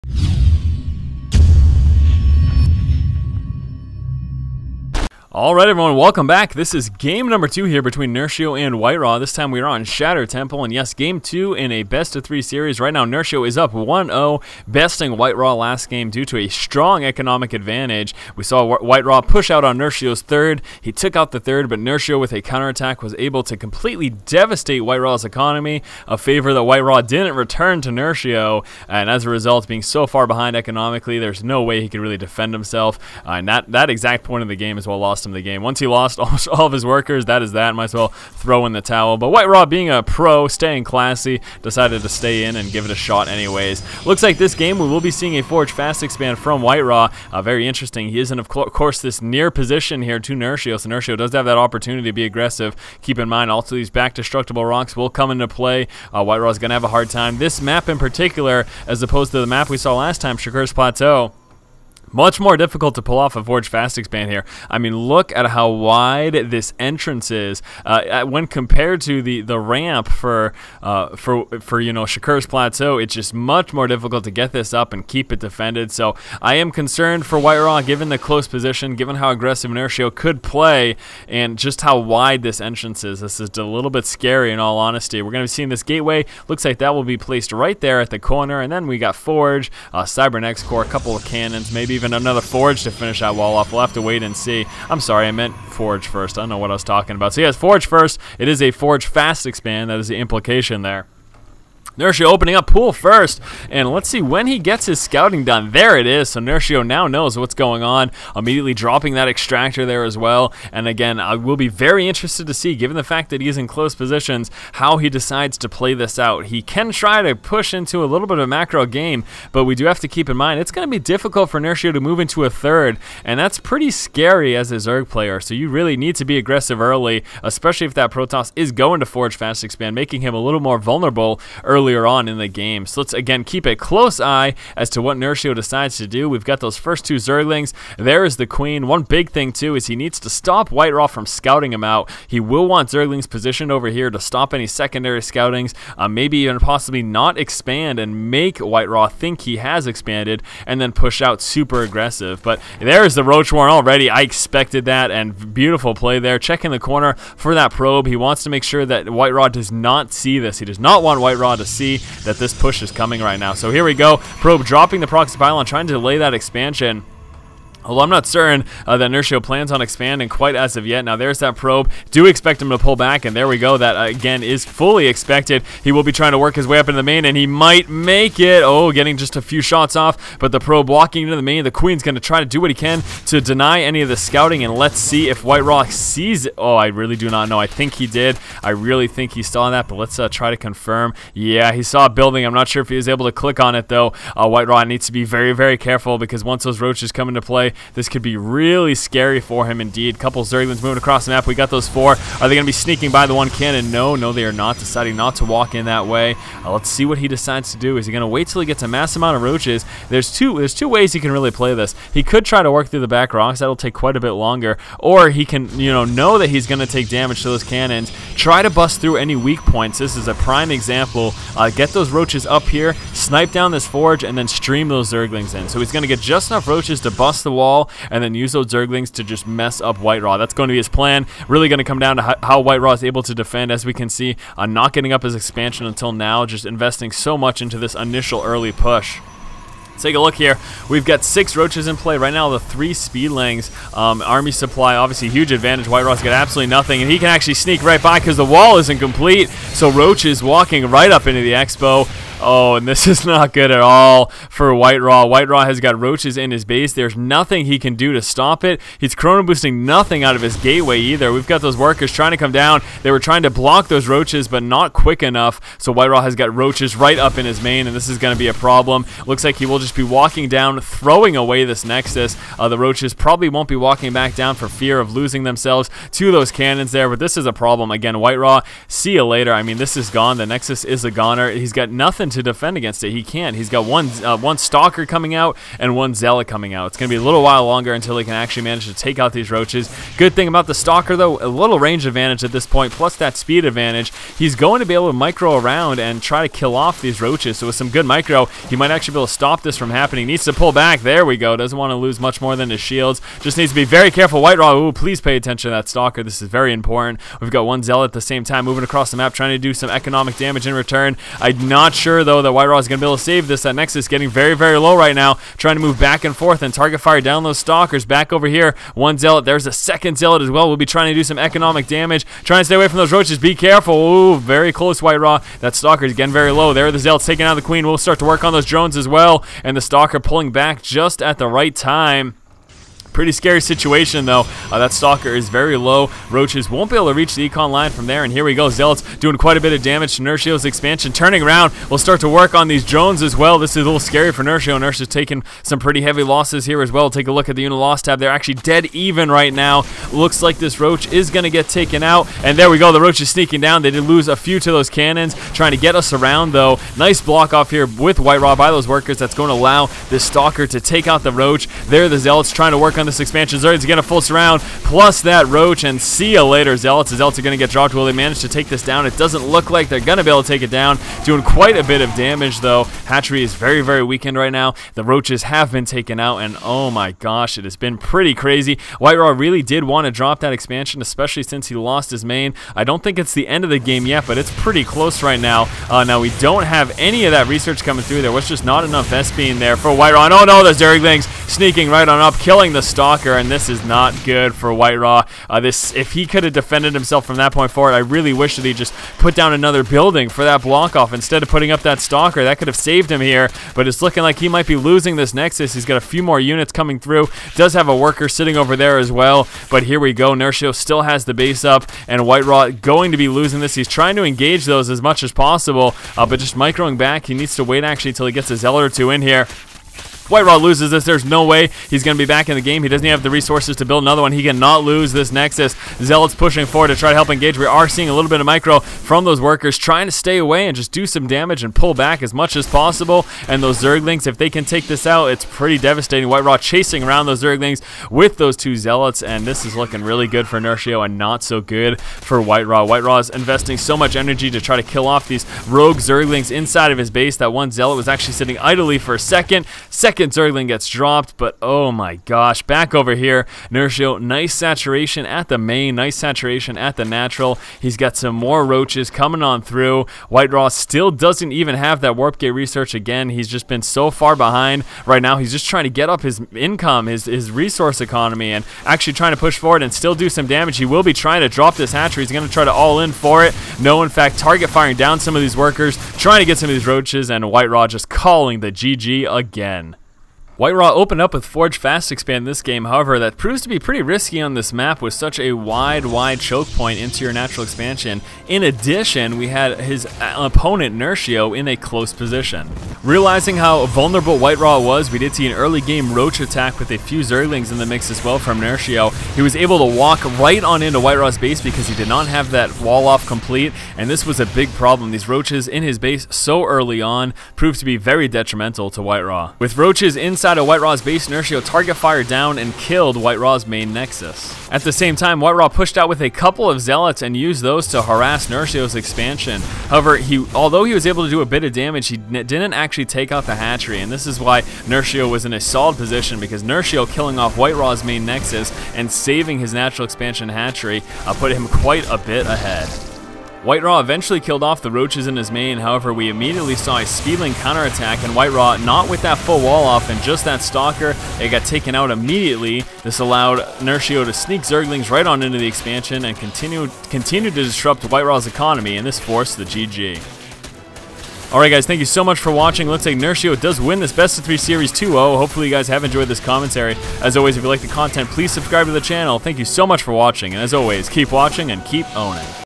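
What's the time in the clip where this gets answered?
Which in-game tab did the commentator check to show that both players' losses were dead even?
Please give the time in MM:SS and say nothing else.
05:47.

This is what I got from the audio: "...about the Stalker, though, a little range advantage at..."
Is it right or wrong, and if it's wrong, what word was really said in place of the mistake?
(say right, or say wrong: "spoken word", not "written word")
right.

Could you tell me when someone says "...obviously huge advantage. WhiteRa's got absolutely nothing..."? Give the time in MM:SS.
04:04.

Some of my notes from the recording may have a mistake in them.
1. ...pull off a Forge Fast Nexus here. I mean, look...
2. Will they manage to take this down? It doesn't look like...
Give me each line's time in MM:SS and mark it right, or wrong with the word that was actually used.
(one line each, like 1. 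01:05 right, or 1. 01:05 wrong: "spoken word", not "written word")
1. 01:03 wrong: "Expand", not "Nexus"
2. 06:07 right.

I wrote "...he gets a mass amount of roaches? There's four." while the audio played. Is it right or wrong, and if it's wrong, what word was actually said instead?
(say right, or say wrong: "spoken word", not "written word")
wrong: "two", not "four".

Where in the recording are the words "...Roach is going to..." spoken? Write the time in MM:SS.
05:50.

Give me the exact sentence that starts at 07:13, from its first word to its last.
And those Zerglings, if they can take this out, it's pretty devastating.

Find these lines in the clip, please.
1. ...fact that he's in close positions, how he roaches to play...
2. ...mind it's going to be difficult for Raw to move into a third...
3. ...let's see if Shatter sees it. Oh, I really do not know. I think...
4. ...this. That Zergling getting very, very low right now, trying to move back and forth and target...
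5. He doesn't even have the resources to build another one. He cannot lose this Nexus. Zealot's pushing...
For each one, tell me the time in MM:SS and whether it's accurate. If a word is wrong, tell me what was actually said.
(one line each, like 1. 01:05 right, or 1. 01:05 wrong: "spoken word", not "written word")
1. 01:53 wrong: "decides", not "roaches"
2. 02:00 wrong: "Nerchio", not "Raw"
3. 03:04 wrong: "WhiteRa", not "Shatter"
4. 05:13 wrong: "Nexus", not "Zergling"
5. 07:02 right.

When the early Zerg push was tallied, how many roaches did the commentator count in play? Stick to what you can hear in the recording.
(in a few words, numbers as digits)
6.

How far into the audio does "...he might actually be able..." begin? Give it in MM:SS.
04:58.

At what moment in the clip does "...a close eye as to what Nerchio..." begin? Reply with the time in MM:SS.
02:13.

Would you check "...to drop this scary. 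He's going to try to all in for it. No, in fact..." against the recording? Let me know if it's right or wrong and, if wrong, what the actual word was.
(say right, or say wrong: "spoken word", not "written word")
wrong: "hatchery", not "scary".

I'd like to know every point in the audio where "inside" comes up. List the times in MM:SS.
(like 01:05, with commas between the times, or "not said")
07:26, 08:30.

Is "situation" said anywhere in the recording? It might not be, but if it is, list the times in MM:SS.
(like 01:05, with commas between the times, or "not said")
05:33.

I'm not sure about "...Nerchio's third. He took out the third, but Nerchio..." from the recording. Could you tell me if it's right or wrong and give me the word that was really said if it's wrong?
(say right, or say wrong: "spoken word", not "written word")
right.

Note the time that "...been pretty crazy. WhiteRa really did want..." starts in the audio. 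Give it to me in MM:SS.
06:17.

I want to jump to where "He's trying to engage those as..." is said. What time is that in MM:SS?
06:53.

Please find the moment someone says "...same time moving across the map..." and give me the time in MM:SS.
05:08.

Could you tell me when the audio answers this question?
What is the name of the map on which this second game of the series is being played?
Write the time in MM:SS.
00:09.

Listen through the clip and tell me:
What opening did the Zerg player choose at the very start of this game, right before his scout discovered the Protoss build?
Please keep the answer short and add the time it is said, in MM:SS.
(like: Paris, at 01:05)
Pool first, at 01:42.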